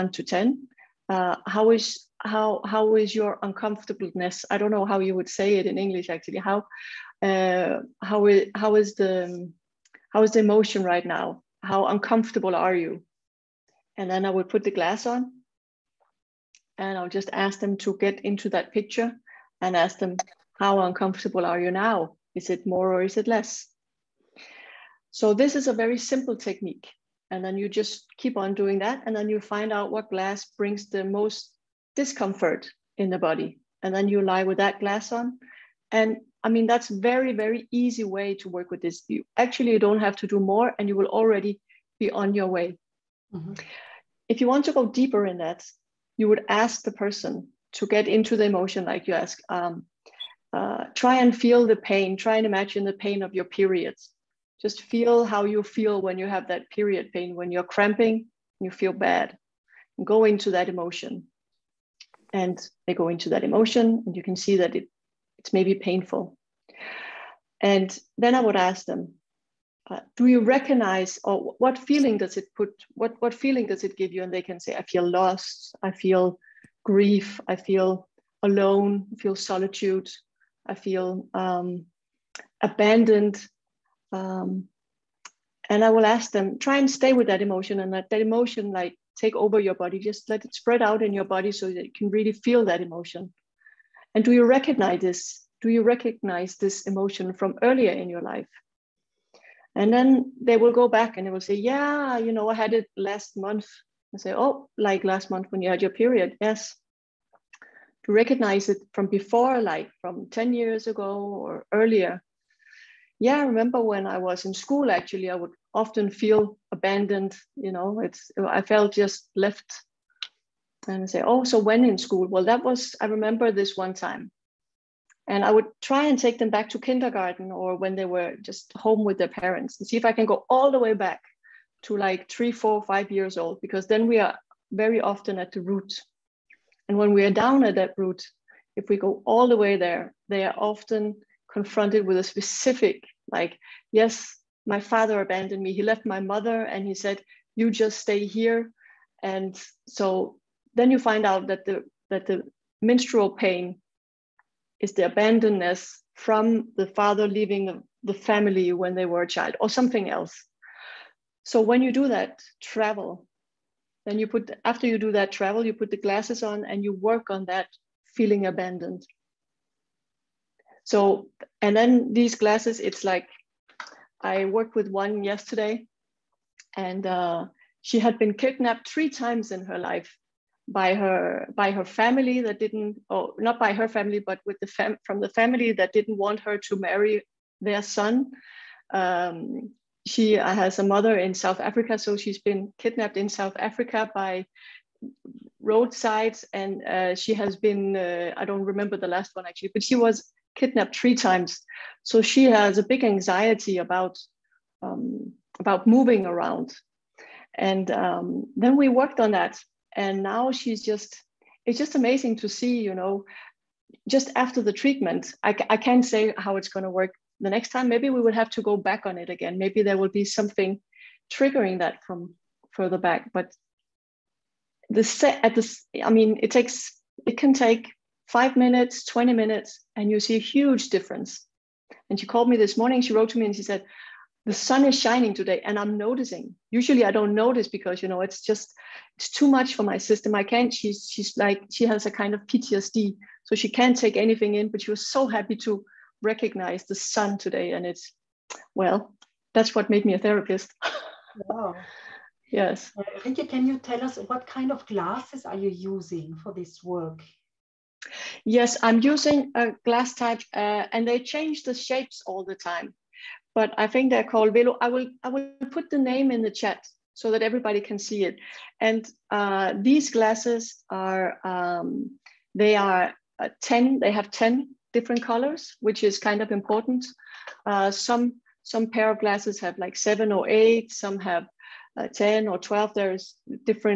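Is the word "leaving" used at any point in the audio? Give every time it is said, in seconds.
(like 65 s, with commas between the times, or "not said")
157 s.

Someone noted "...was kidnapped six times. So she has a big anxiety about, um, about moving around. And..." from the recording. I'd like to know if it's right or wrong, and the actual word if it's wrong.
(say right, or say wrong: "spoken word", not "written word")
wrong: "three", not "six".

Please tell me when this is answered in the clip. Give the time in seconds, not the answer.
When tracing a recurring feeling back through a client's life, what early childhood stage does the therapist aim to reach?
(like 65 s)
126 s.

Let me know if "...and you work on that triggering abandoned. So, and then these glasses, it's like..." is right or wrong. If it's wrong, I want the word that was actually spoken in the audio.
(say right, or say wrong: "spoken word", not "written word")
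wrong: "feeling", not "triggering".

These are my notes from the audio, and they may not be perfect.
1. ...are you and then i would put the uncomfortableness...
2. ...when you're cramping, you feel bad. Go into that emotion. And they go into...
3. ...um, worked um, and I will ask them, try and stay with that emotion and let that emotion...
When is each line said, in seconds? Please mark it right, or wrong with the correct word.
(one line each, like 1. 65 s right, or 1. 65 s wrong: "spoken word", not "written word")
1. 12 s wrong: "glass", not "uncomfortableness"
2. 57 s right
3. 81 s wrong: "abandoned", not "worked".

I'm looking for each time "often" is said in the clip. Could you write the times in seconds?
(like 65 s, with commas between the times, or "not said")
115 s, 134 s, 140 s.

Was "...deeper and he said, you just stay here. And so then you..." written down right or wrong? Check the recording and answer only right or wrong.
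wrong.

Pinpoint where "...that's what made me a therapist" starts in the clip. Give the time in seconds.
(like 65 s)
249 s.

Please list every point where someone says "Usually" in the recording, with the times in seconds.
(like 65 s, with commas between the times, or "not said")
236 s.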